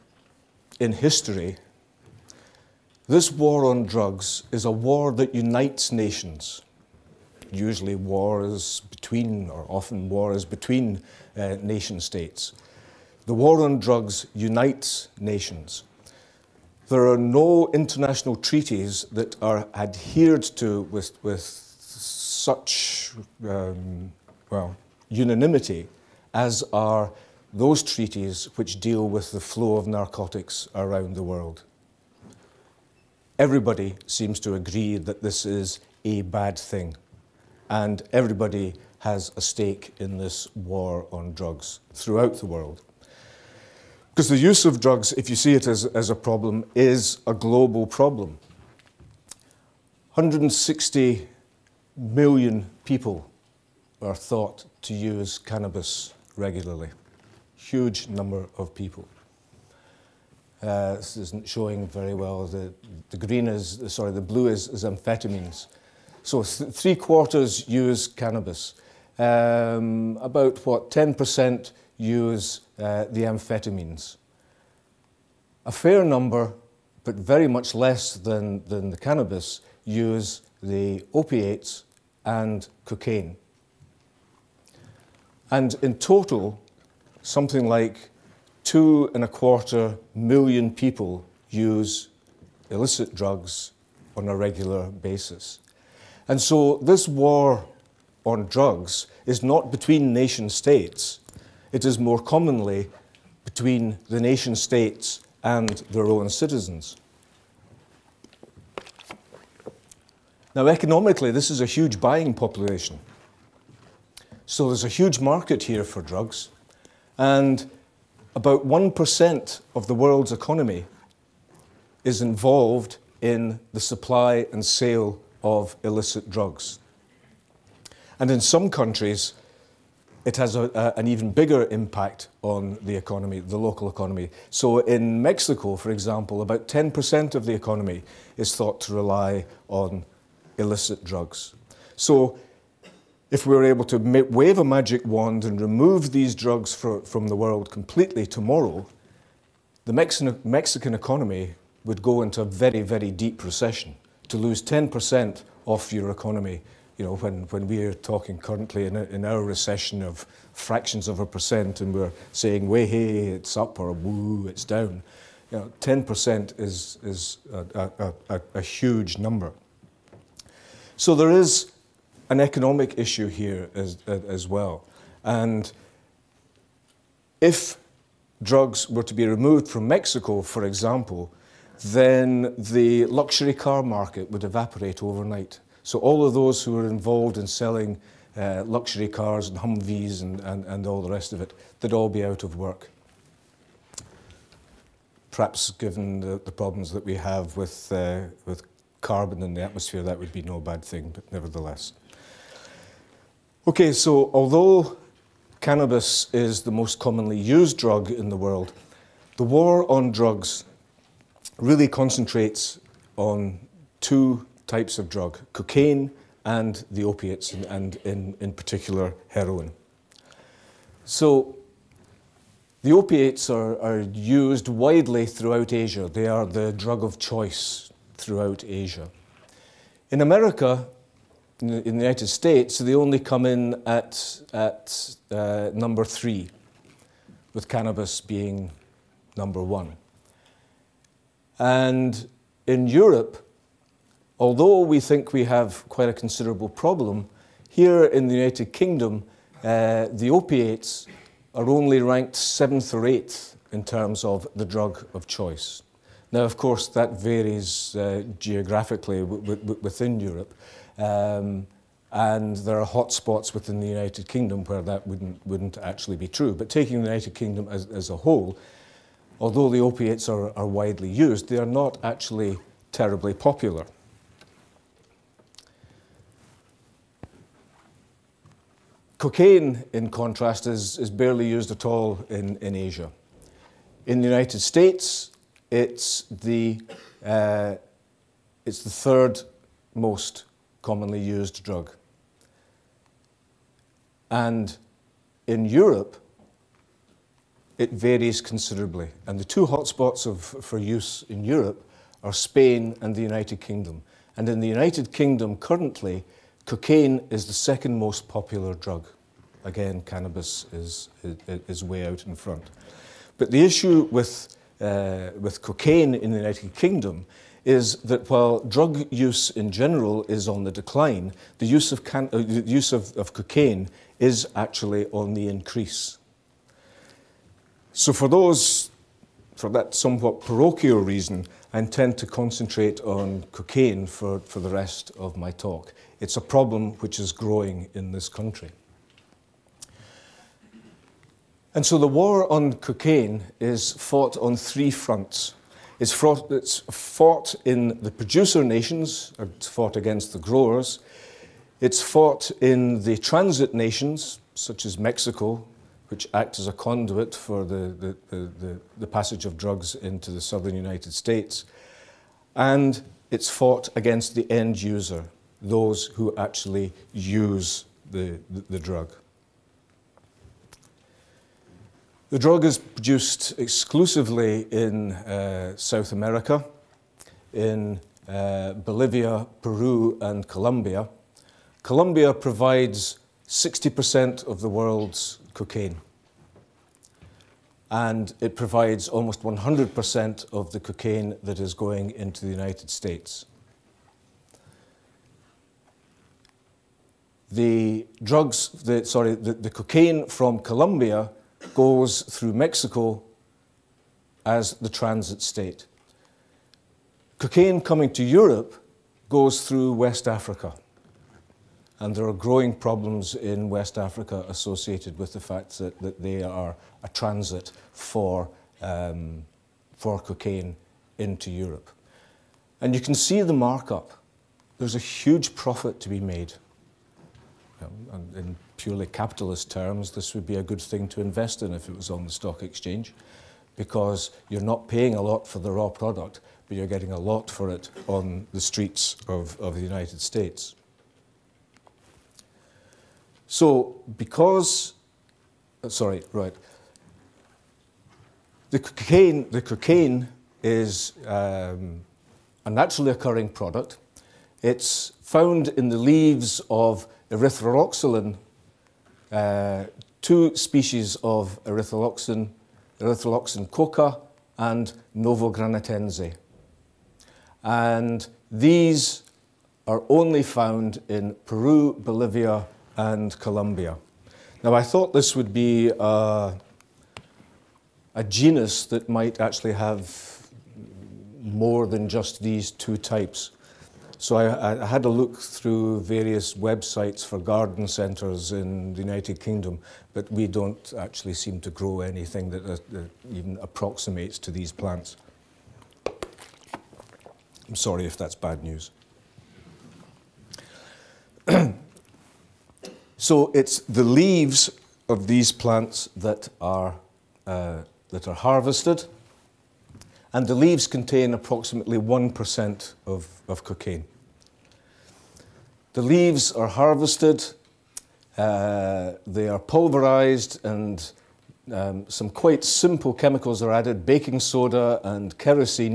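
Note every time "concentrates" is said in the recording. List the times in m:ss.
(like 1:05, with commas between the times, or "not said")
3:31, 5:32.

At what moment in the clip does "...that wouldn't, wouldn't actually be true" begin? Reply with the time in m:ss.
4:24.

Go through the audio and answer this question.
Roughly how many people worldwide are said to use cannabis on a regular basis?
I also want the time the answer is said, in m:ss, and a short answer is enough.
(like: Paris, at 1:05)
160 million, at 0:50.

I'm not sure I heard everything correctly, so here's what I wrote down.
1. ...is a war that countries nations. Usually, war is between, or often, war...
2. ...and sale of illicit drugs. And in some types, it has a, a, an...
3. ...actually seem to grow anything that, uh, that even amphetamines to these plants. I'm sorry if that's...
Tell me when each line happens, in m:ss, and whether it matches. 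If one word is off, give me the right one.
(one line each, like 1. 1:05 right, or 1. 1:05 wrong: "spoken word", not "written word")
1. 0:04 wrong: "unites", not "countries"
2. 2:04 wrong: "countries", not "types"
3. 8:10 wrong: "approximates", not "amphetamines".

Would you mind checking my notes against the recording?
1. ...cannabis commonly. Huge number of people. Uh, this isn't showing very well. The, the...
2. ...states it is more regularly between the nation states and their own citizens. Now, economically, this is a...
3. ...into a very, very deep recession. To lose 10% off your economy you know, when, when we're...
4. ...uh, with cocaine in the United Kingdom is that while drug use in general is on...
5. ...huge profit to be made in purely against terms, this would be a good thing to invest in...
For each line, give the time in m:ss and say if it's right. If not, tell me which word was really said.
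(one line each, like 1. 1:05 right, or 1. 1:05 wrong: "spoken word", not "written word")
1. 0:55 wrong: "regularly", not "commonly"
2. 1:40 wrong: "commonly", not "regularly"
3. 2:32 right
4. 5:14 right
5. 7:04 wrong: "capitalist", not "against".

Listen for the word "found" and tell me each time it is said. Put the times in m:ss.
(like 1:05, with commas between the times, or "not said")
7:35, 7:50.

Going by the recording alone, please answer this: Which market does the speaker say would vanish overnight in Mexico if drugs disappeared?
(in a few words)
luxury car market.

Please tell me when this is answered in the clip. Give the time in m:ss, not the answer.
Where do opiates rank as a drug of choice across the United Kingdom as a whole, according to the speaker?
4:12.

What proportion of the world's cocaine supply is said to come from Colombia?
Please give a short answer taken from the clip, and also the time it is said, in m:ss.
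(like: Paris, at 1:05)
60%, at 6:23.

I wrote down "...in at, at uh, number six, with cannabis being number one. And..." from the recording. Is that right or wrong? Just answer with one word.
wrong.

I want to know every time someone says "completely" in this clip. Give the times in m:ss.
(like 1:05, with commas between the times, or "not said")
2:27.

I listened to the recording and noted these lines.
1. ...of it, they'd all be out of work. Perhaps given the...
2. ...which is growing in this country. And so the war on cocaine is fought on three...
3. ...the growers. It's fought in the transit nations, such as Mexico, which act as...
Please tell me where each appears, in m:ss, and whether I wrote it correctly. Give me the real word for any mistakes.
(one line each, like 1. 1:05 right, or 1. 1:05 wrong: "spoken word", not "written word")
1. 3:11 right
2. 5:36 right
3. 5:50 right.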